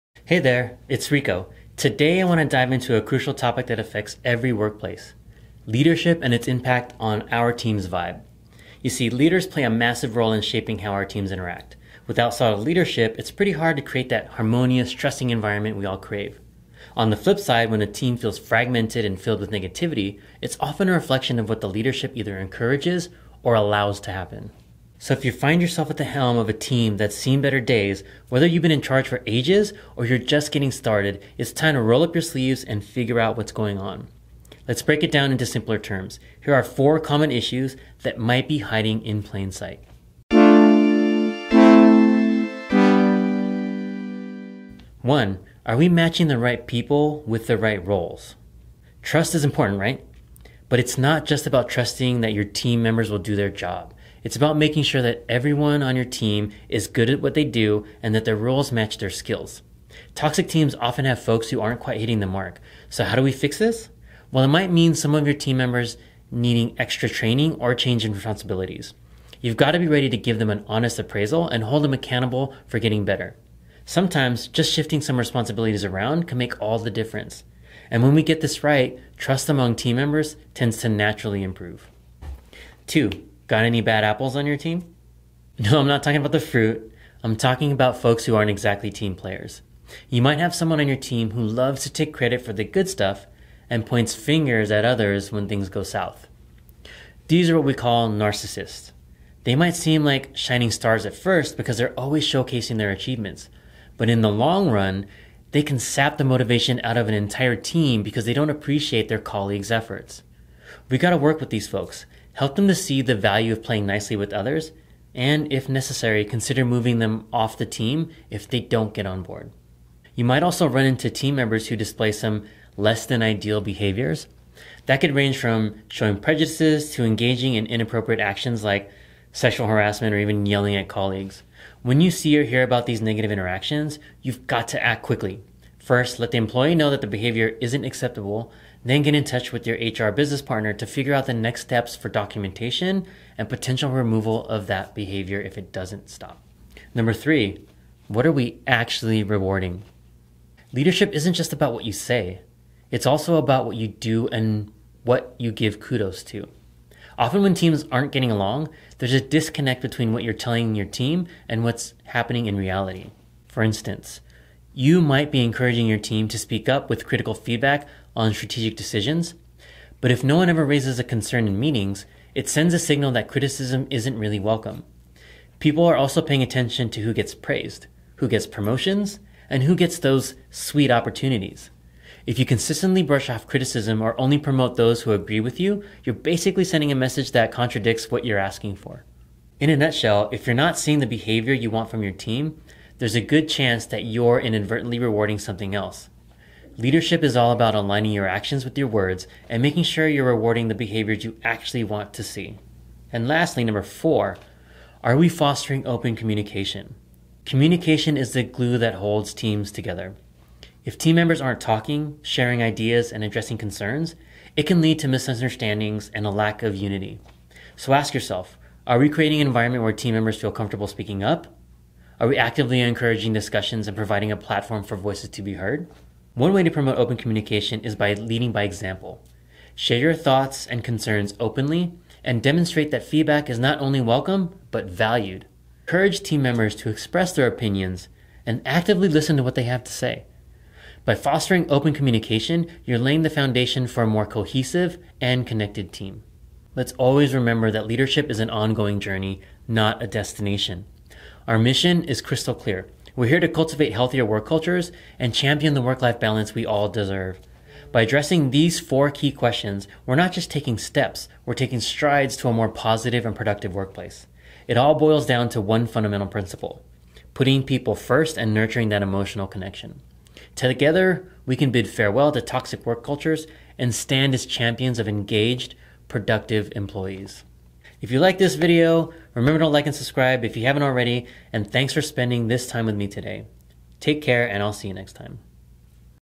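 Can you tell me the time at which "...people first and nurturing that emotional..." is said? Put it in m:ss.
4:27.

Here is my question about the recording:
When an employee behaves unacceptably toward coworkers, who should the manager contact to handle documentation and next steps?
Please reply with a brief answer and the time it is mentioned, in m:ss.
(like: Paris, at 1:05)
HR business partner, at 2:19.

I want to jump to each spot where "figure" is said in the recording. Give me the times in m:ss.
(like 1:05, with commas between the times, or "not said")
0:32, 2:20.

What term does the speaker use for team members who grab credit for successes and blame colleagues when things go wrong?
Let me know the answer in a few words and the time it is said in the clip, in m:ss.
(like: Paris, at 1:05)
narcissists, at 1:38.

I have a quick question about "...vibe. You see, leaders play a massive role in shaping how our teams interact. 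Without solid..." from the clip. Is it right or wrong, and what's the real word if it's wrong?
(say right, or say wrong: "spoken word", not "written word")
right.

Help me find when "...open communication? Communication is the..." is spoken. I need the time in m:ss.
3:25.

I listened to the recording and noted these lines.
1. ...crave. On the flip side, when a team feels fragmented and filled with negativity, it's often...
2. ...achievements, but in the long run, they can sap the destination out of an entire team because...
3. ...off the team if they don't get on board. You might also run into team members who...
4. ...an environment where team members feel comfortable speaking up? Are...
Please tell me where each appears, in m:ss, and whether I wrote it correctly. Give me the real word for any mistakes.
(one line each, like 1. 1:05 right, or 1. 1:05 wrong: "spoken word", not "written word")
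1. 0:15 right
2. 1:42 wrong: "motivation", not "destination"
3. 1:57 right
4. 3:39 right.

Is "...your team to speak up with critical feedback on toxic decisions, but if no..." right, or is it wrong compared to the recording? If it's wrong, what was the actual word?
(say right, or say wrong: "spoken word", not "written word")
wrong: "strategic", not "toxic".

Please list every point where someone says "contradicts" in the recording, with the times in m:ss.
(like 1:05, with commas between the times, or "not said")
3:07.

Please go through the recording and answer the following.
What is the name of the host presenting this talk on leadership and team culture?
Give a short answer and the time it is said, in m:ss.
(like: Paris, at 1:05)
Rico, at 0:01.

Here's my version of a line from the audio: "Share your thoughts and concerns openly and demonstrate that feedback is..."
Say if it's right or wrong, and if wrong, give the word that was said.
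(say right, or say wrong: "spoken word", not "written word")
right.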